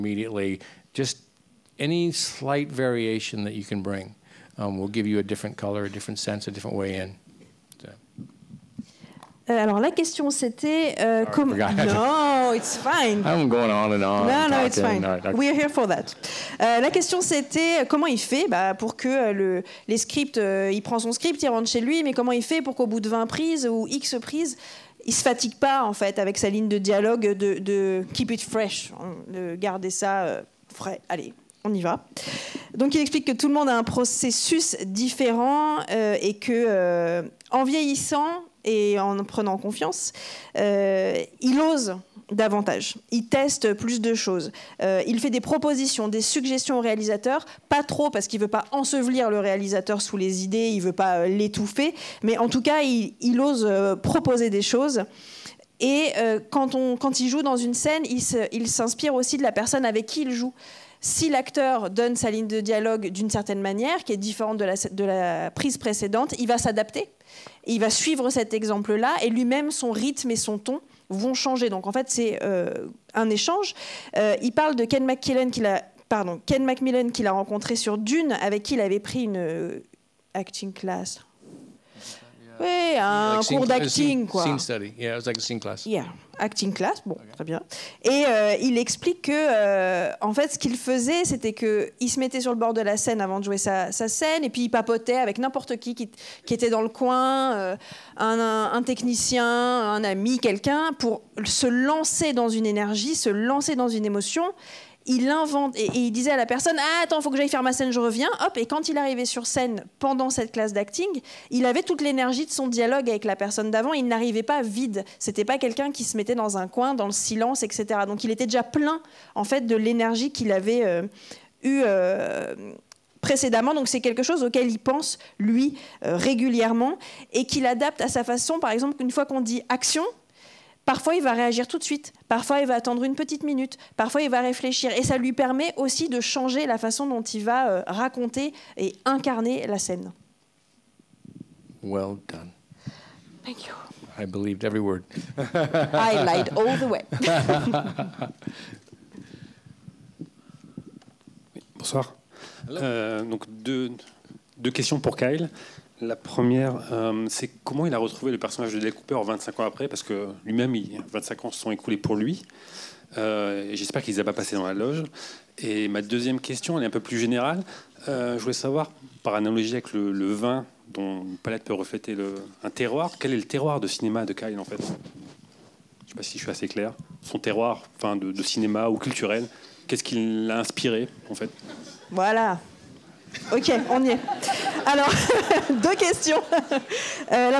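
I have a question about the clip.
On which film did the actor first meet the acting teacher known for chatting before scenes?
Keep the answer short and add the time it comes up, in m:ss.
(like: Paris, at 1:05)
Dune, at 1:17.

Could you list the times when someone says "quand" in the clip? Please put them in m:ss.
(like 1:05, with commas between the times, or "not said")
0:56, 1:48.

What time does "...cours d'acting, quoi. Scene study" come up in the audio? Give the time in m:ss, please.
1:23.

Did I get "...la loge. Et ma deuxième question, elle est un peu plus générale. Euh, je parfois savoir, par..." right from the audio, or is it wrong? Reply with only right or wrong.
wrong.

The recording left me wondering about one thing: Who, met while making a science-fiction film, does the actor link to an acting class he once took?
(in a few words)
Ken MacMillan.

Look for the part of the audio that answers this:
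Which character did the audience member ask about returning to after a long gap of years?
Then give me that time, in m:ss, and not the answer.
2:38.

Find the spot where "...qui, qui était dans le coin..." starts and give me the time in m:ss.
1:35.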